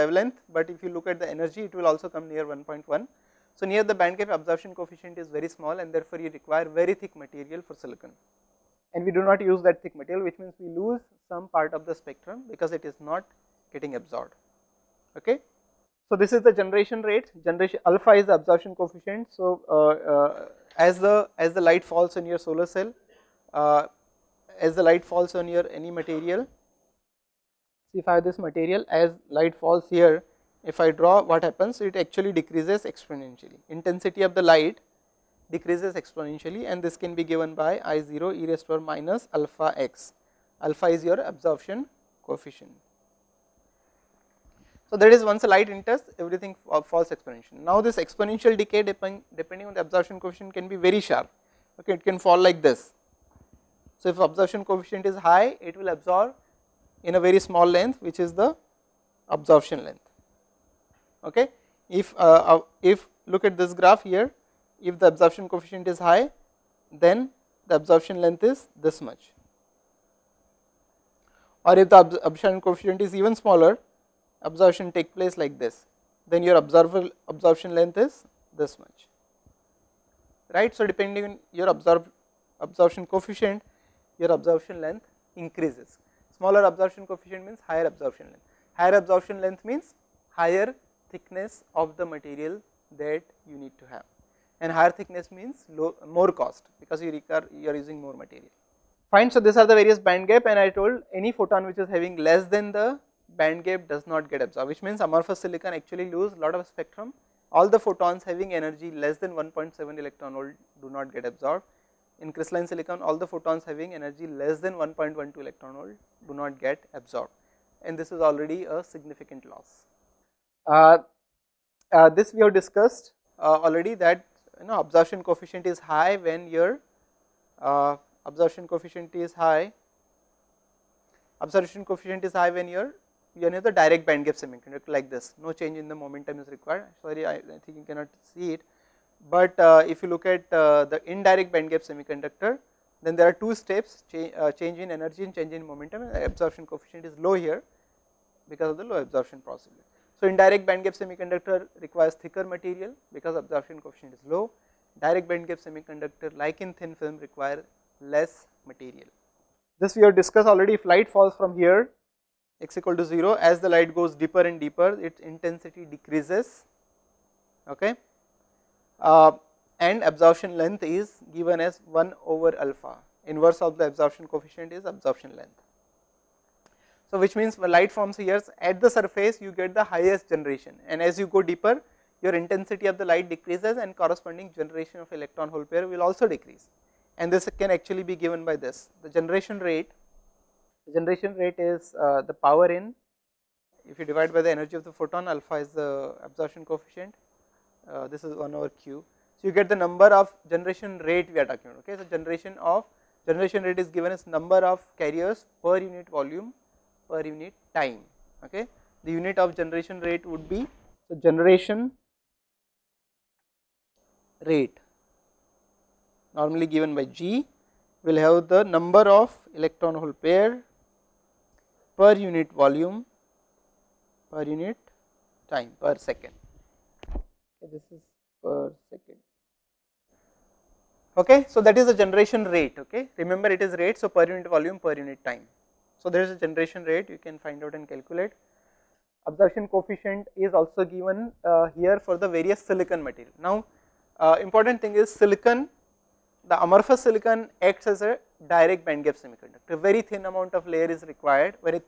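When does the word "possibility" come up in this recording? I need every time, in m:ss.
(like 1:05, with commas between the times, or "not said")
2:29.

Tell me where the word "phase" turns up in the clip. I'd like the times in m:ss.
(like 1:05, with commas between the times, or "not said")
not said.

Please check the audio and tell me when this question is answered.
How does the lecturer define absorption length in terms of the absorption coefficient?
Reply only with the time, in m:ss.
2:51.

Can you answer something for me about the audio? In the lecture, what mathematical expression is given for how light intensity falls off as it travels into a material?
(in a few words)
I0 e^(-alpha x).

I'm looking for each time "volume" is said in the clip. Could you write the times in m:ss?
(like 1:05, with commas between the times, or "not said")
3:26, 3:42, 3:54.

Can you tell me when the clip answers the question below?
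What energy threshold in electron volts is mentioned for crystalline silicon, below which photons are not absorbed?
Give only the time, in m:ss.
1:54.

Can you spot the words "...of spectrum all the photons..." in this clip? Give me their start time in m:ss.
1:46.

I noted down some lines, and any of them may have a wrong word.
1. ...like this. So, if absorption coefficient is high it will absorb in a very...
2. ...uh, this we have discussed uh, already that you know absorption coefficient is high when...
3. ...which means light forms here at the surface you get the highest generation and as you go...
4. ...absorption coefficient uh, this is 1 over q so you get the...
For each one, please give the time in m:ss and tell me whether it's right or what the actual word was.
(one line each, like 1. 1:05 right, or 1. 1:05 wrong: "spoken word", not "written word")
1. 0:52 right
2. 2:01 right
3. 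2:57 right
4. 3:16 right.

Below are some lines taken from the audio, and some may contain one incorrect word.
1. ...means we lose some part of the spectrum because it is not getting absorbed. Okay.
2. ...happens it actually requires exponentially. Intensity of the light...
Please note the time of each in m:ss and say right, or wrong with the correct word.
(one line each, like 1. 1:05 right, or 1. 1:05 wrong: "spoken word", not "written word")
1. 0:10 right
2. 0:31 wrong: "decreases", not "requires".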